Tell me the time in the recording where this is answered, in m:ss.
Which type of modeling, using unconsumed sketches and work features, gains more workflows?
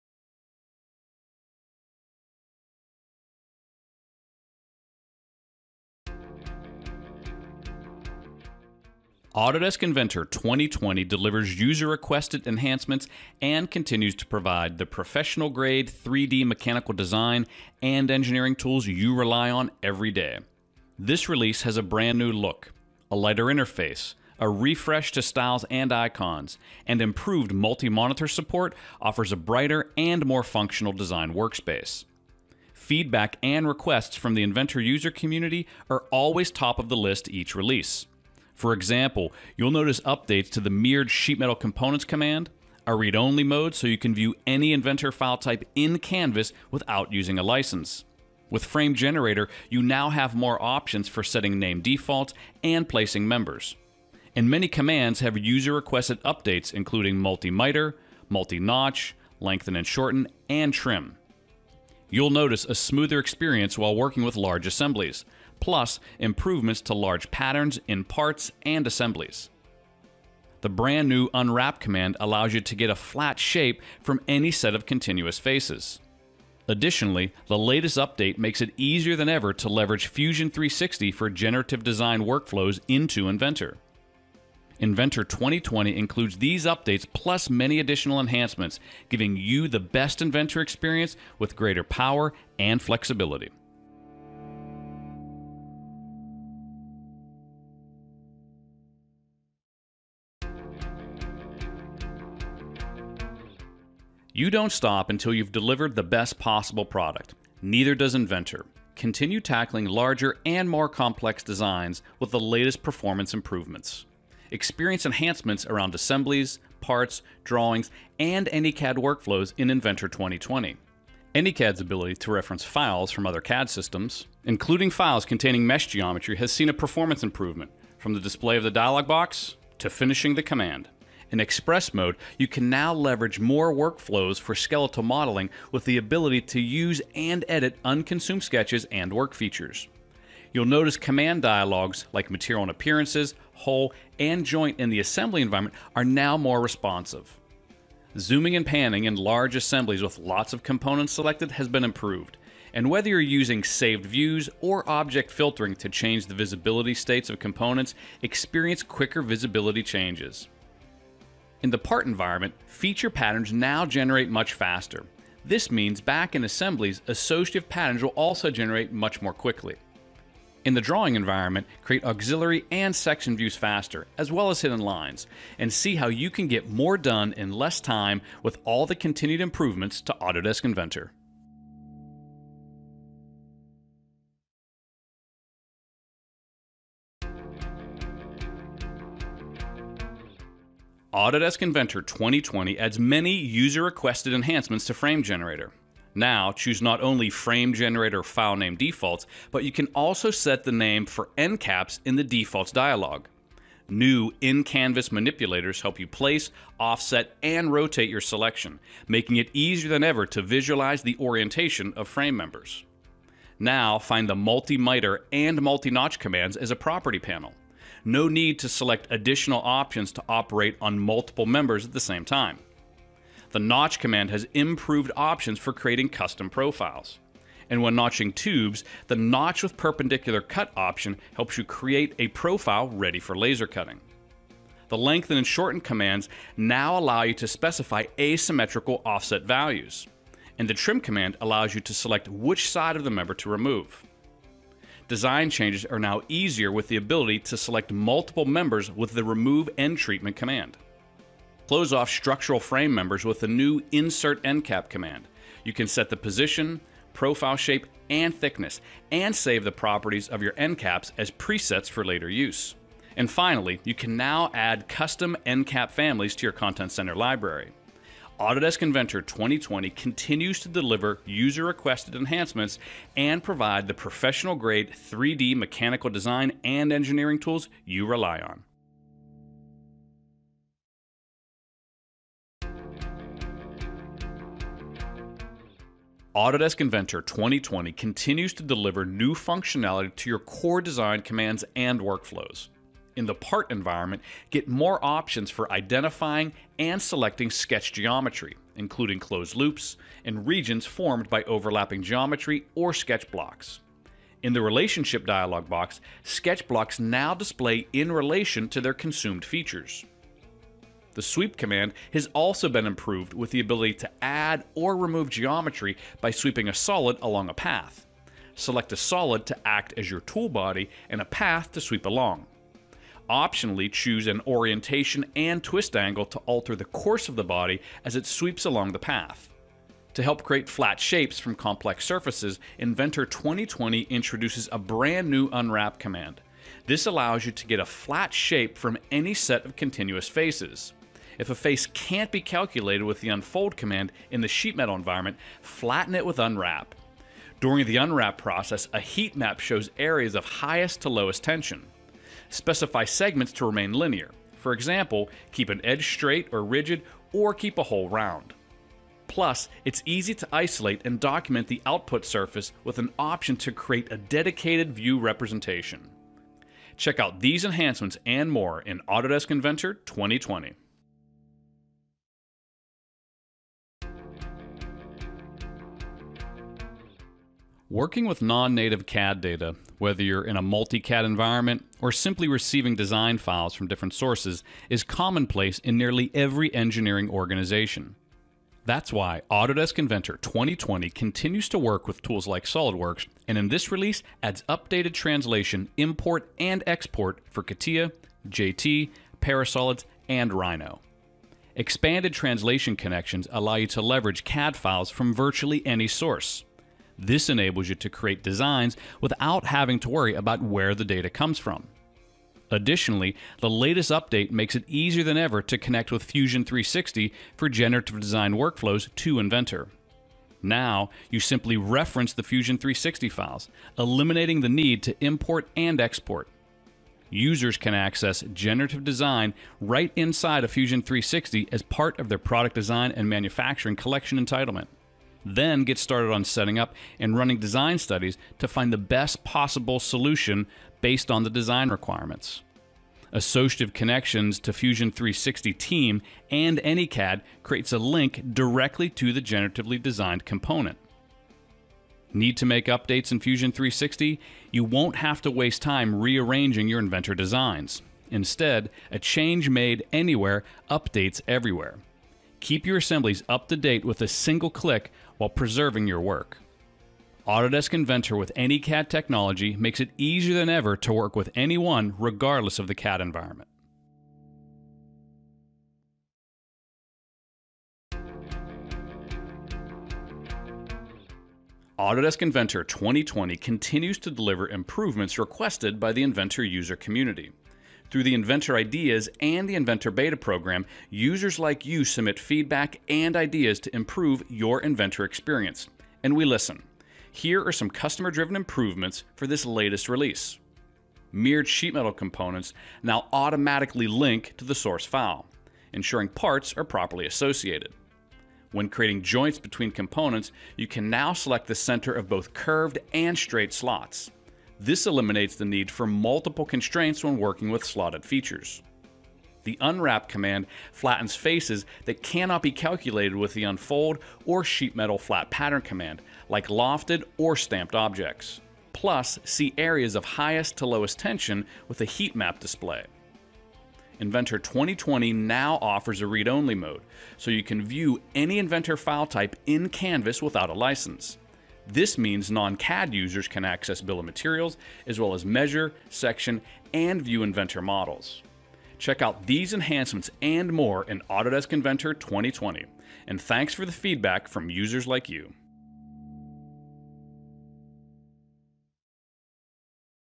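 2:14.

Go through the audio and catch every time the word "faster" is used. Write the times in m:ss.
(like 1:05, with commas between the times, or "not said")
2:44, 2:53.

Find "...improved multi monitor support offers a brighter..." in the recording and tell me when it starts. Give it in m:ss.
0:27.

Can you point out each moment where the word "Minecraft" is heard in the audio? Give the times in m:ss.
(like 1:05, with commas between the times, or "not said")
not said.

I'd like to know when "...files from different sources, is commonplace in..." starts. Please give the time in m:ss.
6:23.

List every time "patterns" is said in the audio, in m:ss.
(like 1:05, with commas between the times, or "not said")
1:07, 2:43, 2:47, 8:45.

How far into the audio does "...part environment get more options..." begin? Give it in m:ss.
4:53.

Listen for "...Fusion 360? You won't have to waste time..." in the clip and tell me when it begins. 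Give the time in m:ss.
7:33.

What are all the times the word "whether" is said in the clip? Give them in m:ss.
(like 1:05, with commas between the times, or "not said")
2:32, 6:20.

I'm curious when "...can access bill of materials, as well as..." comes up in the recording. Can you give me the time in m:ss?
9:03.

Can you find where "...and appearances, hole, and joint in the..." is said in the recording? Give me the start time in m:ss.
2:22.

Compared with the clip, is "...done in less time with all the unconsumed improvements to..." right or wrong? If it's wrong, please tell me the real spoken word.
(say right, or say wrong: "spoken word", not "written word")
wrong: "continued", not "unconsumed".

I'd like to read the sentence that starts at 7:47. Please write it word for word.
Autodesk Inventor with AnyCAD technology makes it easier than ever to work with anyone regardless of the CAD environment.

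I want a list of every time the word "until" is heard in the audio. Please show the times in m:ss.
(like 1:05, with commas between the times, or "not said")
1:45.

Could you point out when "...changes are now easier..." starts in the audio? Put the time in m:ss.
4:05.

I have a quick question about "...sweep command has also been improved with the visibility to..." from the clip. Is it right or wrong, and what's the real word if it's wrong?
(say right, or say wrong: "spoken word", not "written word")
wrong: "ability", not "visibility".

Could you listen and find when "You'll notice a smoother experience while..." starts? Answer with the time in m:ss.
1:02.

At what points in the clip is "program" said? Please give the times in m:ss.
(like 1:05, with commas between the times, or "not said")
8:10.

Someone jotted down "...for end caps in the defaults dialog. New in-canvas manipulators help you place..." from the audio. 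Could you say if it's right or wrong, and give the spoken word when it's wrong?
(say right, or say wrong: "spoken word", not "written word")
right.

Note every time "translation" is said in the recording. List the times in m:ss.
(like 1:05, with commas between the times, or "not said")
6:35, 6:42.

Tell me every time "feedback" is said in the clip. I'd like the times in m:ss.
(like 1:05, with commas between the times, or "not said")
0:32, 8:12, 9:13.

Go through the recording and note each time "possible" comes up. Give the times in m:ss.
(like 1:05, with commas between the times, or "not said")
1:46, 7:19.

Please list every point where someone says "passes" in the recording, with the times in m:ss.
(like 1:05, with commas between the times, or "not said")
not said.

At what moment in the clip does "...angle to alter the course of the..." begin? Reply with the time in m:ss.
5:25.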